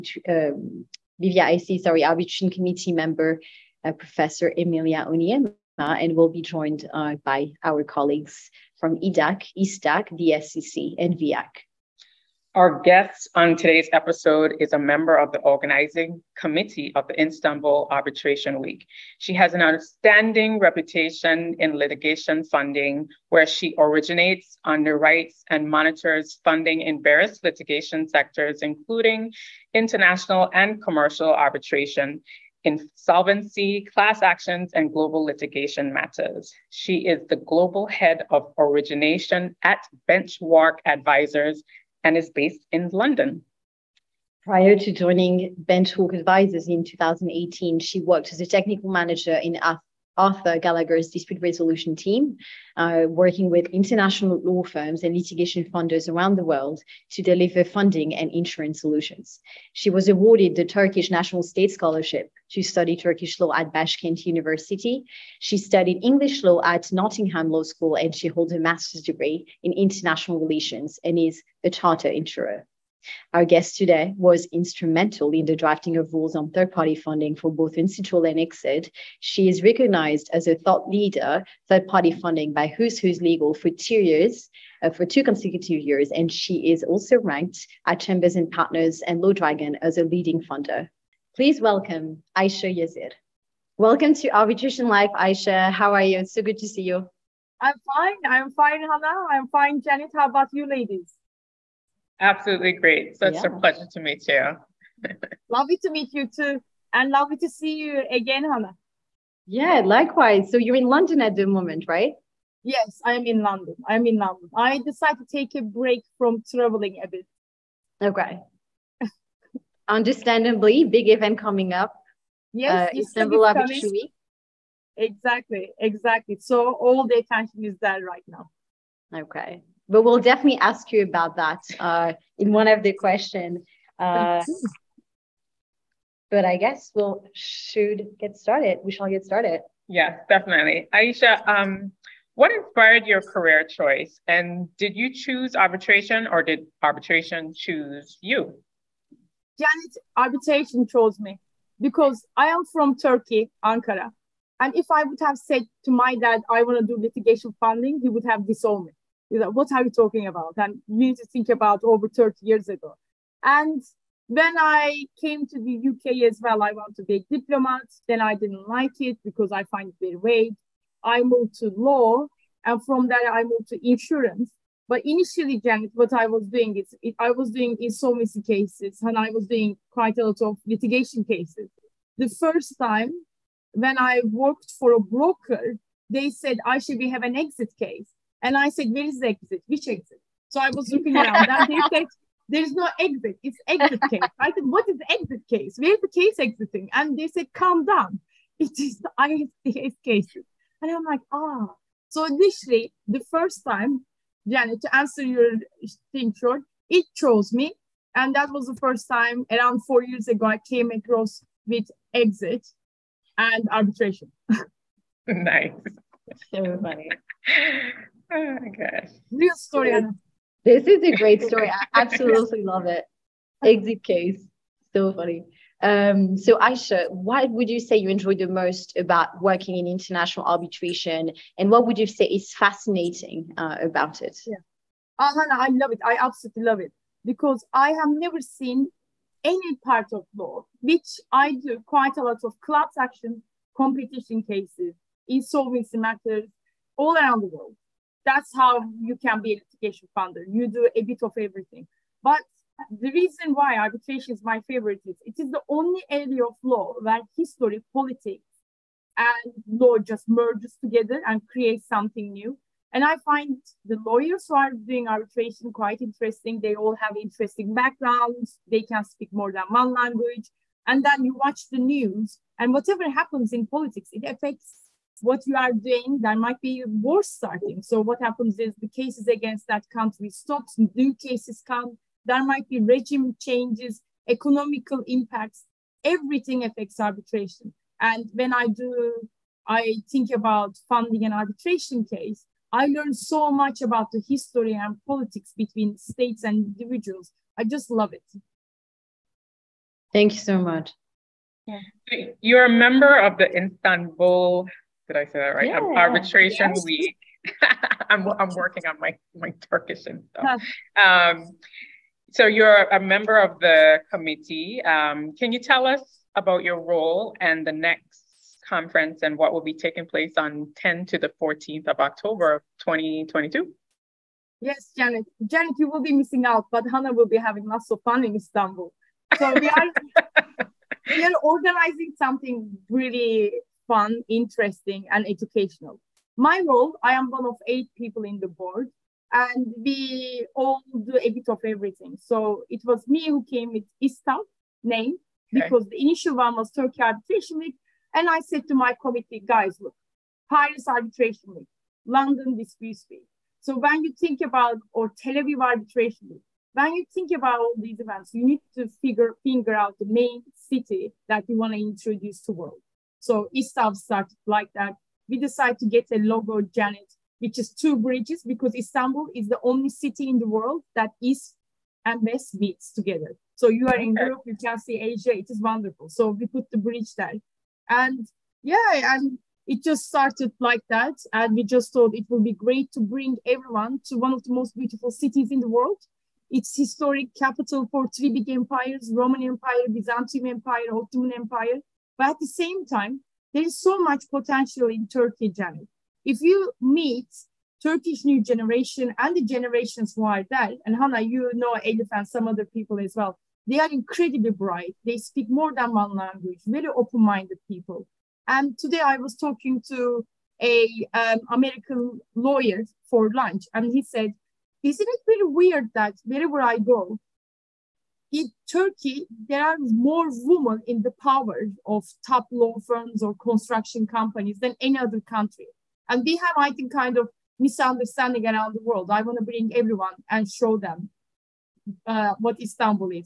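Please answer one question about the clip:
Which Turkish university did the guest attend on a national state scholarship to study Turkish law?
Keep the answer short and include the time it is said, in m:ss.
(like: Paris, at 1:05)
Baskent University, at 1:03.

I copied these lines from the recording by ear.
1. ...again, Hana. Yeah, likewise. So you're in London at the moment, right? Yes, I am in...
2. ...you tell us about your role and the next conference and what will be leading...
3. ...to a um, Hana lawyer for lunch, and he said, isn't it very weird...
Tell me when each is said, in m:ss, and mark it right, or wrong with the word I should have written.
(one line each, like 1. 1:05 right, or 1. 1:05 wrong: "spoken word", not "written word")
1. 1:48 right
2. 5:15 wrong: "taking", not "leading"
3. 6:49 wrong: "American", not "Hana".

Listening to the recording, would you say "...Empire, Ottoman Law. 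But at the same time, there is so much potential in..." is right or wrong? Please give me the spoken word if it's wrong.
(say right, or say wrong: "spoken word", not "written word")
wrong: "Empire", not "Law".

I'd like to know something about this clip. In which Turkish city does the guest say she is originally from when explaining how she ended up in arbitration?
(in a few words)
Ankara.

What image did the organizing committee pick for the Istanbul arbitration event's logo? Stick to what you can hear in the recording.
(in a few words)
Two bridges.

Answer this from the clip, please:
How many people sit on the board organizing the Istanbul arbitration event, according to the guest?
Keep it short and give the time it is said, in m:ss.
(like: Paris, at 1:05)
8, at 5:37.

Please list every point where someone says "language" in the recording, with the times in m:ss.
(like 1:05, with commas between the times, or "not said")
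4:30, 6:46.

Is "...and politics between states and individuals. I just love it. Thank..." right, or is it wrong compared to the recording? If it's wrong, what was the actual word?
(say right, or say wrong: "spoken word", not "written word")
right.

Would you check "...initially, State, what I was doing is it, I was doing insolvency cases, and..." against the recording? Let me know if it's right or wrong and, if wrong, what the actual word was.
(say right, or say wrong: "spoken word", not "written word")
wrong: "Janet", not "State".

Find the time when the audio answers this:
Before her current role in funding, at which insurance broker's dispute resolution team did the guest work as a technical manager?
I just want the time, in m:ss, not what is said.
0:50.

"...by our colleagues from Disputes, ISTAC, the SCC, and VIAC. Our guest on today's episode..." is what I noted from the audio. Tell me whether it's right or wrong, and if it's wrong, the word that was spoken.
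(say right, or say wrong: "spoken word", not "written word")
wrong: "EDAC", not "Disputes".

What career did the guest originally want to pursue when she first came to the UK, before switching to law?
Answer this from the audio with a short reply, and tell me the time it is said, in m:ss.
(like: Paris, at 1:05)
Diplomat, at 2:47.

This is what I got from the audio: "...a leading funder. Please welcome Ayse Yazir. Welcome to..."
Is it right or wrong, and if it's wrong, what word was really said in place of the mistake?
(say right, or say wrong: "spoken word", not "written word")
right.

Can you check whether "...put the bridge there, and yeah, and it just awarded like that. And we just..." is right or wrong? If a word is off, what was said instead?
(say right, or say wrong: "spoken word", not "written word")
wrong: "started", not "awarded".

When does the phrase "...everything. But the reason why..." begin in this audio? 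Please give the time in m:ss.
4:11.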